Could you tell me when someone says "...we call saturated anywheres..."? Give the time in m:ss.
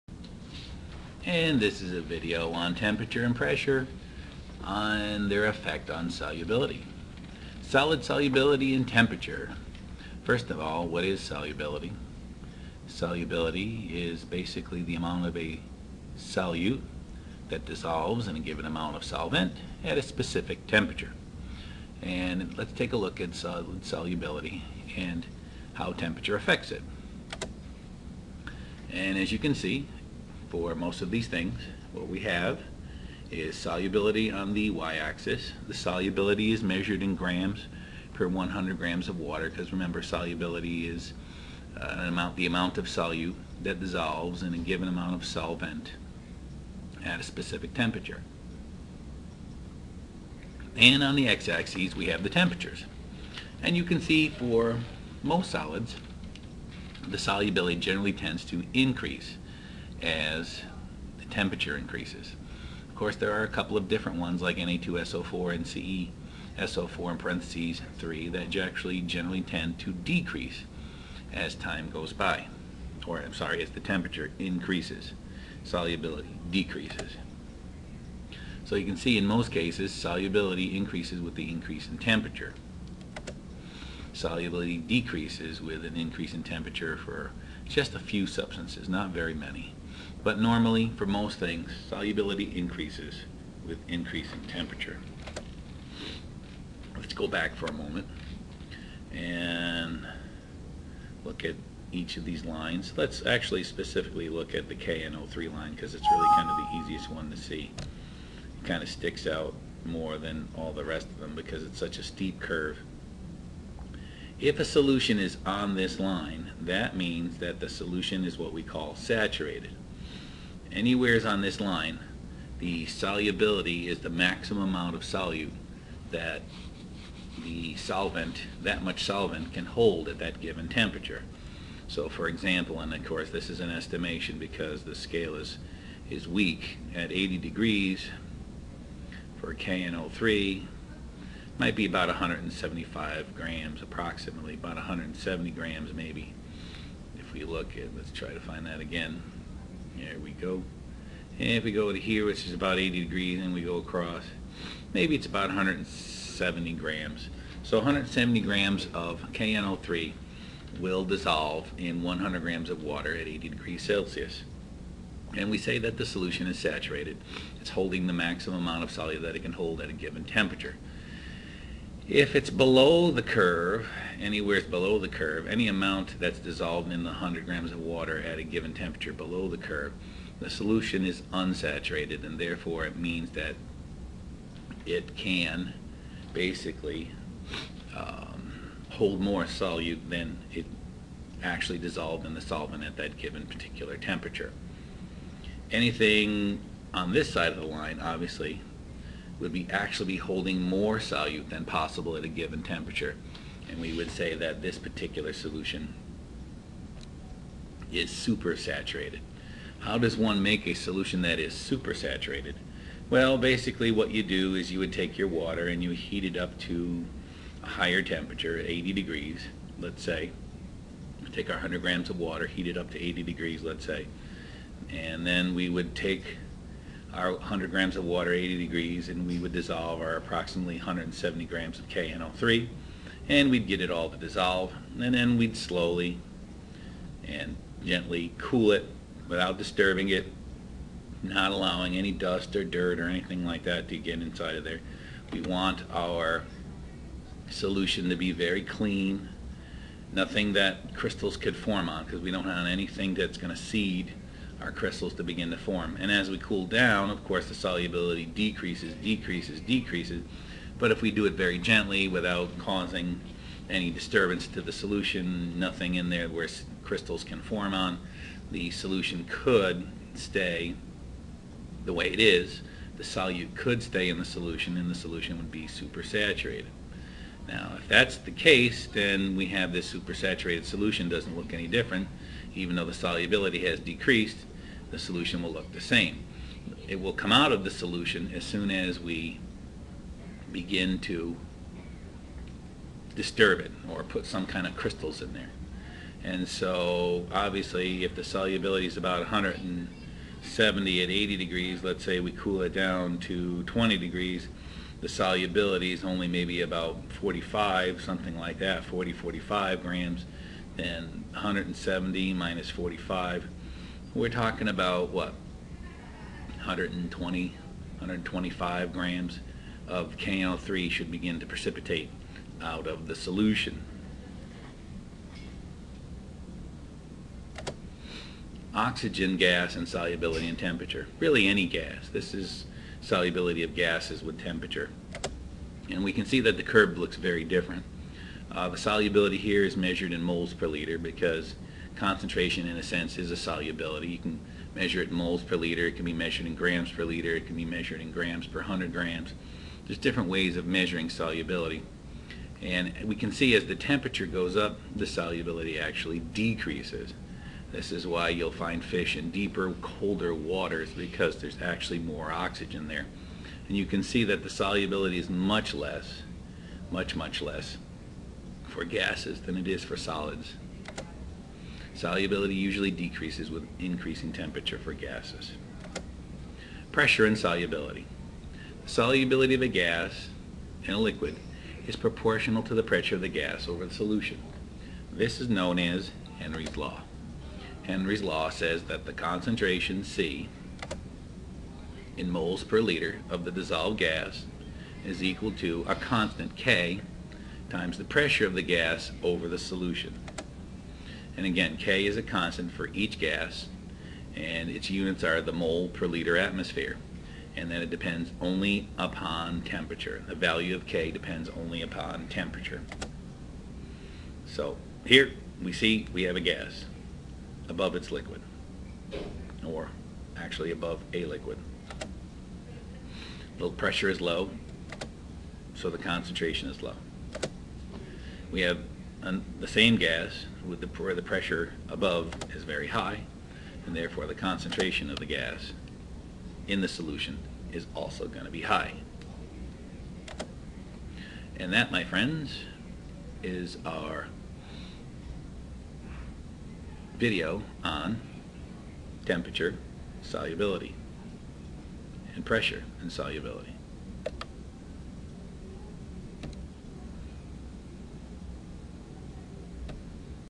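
1:58.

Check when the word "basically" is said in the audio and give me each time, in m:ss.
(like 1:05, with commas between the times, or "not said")
0:14, 3:06, 3:33.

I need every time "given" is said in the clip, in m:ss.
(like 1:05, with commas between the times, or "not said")
0:18, 0:44, 2:10, 2:49, 2:58, 3:13, 3:22.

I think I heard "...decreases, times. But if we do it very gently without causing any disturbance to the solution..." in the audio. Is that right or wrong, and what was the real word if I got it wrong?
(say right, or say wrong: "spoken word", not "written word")
wrong: "decreases", not "times".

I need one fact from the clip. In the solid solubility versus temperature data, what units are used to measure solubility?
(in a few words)
grams per 100 grams of water.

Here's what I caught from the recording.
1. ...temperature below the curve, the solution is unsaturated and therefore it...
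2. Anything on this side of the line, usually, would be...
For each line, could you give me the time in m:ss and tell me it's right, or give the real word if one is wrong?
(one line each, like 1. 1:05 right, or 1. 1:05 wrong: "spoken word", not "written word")
1. 2:58 right
2. 3:15 wrong: "obviously", not "usually".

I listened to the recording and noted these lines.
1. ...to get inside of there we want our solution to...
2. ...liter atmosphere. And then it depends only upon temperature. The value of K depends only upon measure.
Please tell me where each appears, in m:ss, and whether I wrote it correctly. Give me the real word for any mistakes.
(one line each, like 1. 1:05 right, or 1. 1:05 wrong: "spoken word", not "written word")
1. 4:03 right
2. 6:46 wrong: "temperature", not "measure".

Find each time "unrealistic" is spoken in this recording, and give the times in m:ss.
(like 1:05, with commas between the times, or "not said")
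not said.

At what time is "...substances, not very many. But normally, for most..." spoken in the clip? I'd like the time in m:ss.
1:28.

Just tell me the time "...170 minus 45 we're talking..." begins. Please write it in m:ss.
5:11.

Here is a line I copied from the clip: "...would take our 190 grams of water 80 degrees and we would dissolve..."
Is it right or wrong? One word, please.
wrong.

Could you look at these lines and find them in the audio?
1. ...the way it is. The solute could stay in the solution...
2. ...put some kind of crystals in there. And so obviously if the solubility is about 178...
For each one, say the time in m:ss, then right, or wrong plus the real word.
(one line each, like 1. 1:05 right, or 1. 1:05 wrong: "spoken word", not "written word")
1. 4:31 right
2. 4:54 wrong: "170", not "178".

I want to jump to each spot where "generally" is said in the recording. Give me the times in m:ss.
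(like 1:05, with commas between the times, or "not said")
0:57, 1:09.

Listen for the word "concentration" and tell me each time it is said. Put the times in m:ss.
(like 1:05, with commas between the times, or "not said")
5:42, 6:29, 7:05, 7:14.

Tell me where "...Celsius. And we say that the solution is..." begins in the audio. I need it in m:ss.
2:43.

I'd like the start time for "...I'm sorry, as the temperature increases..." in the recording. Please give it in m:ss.
1:13.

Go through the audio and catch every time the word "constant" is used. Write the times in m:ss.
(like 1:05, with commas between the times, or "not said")
6:35, 6:42.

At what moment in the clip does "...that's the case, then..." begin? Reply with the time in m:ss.
4:37.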